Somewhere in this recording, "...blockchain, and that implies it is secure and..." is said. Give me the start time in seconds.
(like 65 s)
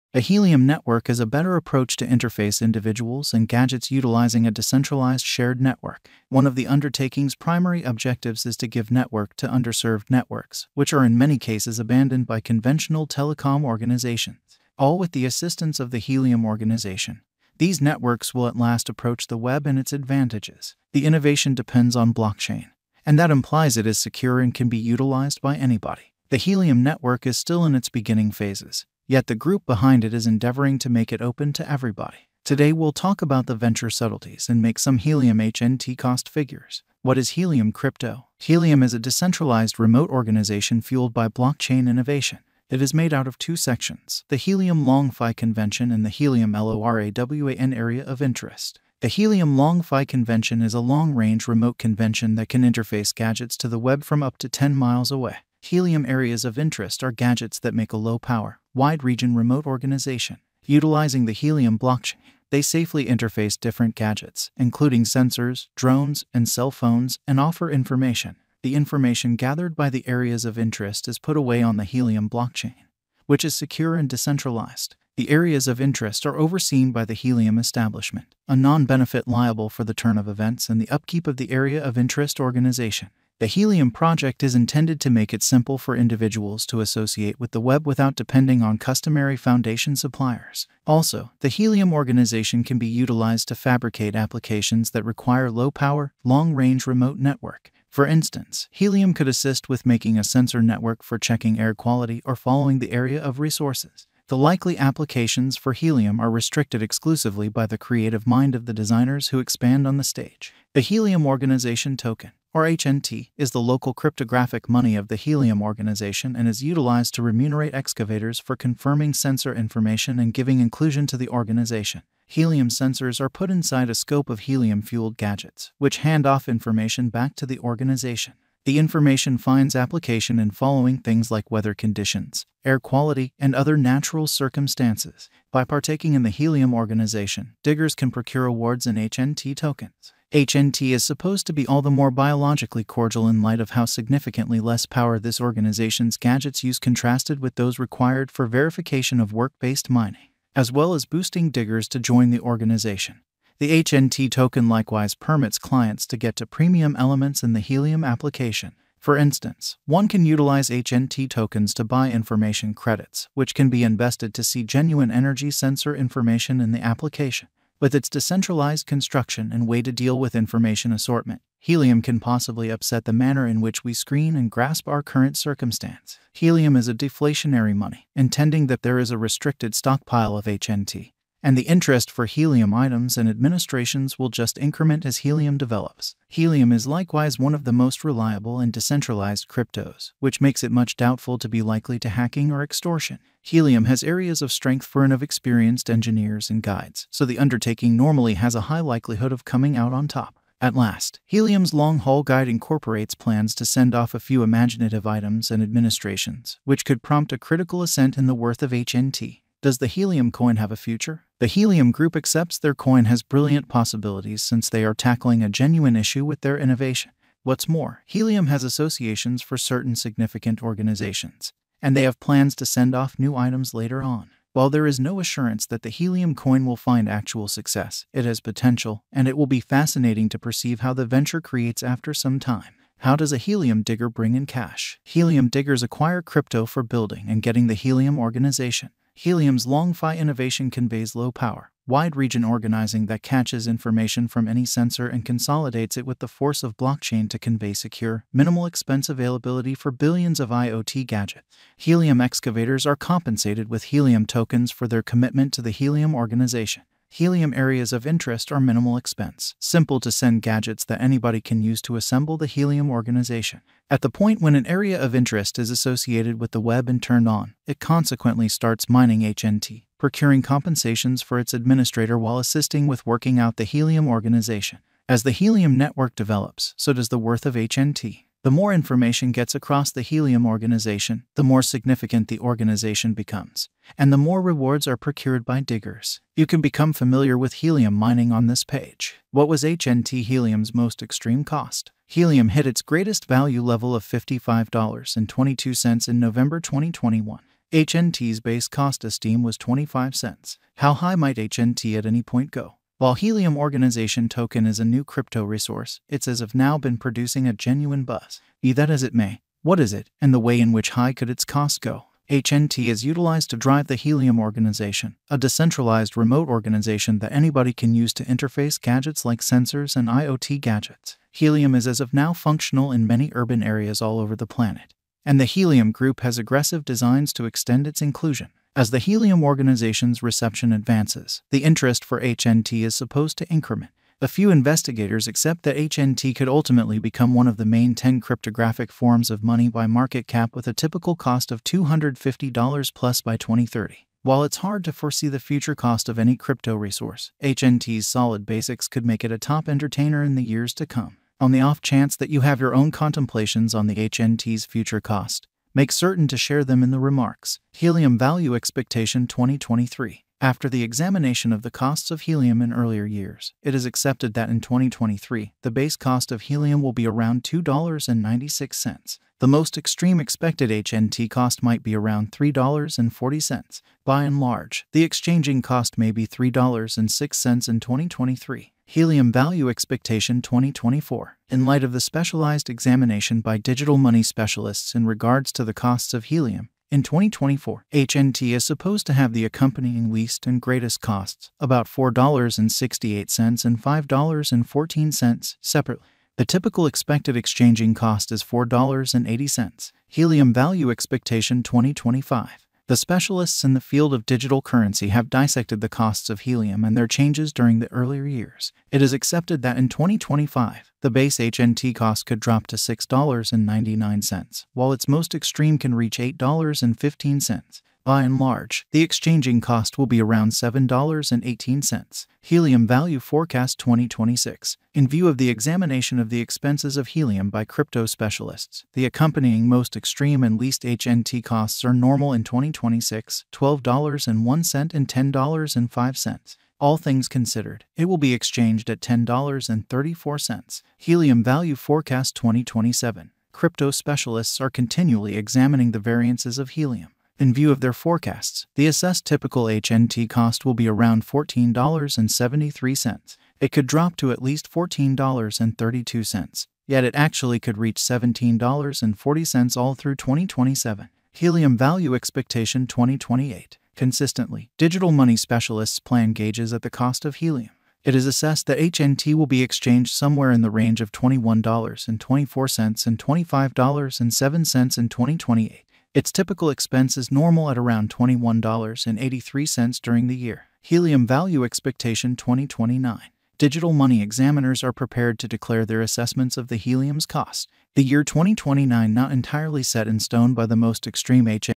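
22 s.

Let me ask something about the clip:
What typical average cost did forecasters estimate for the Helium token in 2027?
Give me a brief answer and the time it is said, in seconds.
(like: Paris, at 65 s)
$14.73, at 451 s.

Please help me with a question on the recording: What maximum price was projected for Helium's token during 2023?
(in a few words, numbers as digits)
$3.40.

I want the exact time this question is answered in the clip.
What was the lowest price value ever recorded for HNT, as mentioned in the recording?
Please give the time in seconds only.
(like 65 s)
299 s.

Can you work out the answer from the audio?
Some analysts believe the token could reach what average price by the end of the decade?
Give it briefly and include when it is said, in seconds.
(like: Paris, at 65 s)
$250, at 341 s.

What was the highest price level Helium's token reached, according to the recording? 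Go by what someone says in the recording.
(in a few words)
$55.22.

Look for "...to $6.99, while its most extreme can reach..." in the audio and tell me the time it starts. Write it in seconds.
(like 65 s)
412 s.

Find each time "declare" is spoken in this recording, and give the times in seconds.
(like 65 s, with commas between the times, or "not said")
485 s.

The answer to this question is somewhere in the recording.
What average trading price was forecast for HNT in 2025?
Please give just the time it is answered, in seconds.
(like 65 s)
420 s.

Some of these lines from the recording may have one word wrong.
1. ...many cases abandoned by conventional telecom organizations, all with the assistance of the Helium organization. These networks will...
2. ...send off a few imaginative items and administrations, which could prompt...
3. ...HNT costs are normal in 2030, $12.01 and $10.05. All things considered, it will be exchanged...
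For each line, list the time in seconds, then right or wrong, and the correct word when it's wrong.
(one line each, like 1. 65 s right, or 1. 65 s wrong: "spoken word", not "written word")
1. 11 s right
2. 203 s right
3. 430 s wrong: "2026", not "2030".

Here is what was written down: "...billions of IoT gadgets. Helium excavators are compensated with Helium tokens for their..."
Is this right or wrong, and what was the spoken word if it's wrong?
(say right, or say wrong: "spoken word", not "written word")
right.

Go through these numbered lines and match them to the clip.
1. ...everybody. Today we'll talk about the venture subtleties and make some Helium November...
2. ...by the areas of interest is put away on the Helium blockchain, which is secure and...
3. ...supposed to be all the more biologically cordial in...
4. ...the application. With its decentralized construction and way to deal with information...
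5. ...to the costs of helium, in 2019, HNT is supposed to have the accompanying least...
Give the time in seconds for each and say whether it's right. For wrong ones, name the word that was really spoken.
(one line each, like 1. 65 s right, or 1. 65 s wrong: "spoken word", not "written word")
1. 31 s wrong: "HNT", not "November"
2. 69 s right
3. 141 s right
4. 166 s right
5. 385 s wrong: "2024", not "2019".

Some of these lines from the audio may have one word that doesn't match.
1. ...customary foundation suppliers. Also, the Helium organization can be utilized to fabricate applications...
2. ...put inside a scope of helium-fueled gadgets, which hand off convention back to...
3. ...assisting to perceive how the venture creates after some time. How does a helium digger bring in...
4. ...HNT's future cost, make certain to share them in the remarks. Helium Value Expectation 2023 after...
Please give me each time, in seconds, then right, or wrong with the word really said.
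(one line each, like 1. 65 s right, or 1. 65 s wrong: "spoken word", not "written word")
1. 88 s right
2. 123 s wrong: "information", not "convention"
3. 229 s wrong: "fascinating", not "assisting"
4. 353 s right.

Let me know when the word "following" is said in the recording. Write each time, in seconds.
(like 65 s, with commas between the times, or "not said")
102 s, 130 s.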